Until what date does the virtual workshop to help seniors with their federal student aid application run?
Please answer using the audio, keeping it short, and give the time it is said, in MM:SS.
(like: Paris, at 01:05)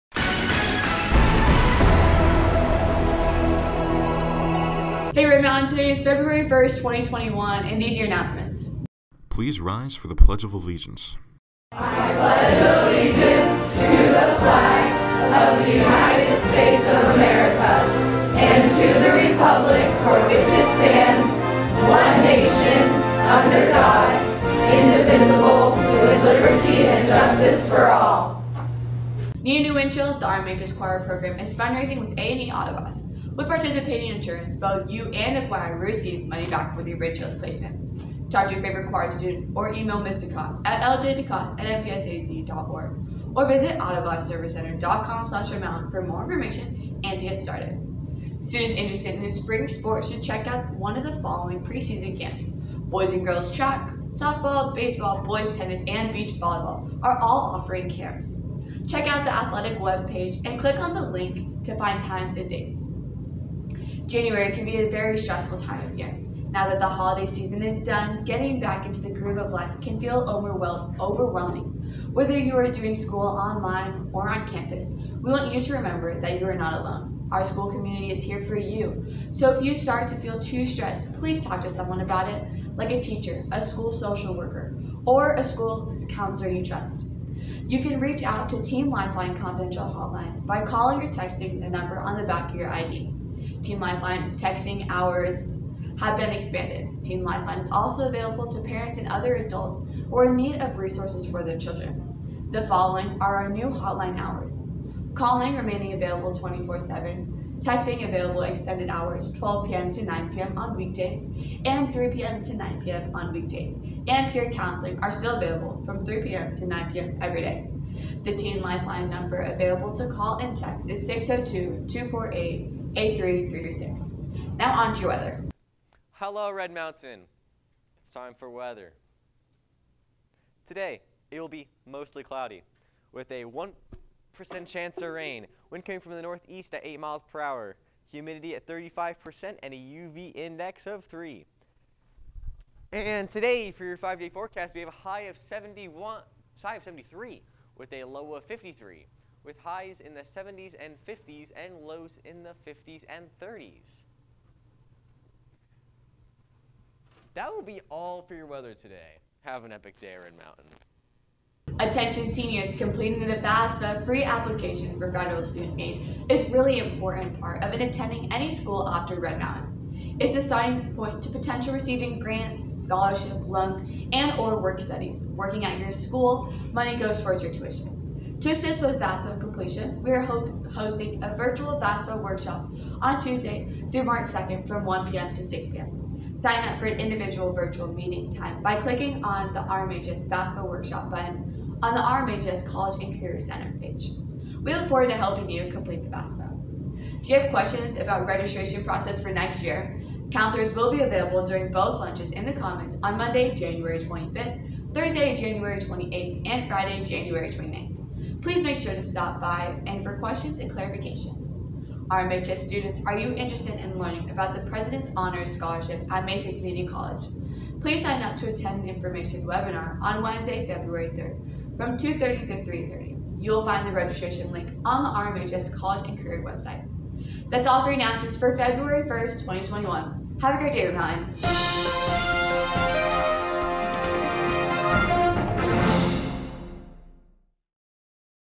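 March 2nd, at 03:04.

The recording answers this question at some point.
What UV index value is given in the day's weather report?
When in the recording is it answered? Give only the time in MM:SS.
02:19.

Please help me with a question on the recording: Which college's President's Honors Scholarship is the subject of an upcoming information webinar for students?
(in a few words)
Mesa Community College.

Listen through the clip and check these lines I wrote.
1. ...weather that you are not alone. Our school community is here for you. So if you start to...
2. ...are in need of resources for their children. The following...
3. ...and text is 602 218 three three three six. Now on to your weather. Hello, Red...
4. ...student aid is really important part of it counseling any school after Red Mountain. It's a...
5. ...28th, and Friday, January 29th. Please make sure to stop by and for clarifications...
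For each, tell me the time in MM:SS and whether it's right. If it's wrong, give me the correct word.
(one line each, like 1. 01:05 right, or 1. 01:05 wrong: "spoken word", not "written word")
1. 01:15 wrong: "remember", not "weather"
2. 01:40 right
3. 02:00 wrong: "248", not "218"
4. 02:45 wrong: "attending", not "counseling"
5. 03:25 wrong: "questions", not "clarifications".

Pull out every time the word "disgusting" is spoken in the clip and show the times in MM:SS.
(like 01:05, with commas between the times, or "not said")
not said.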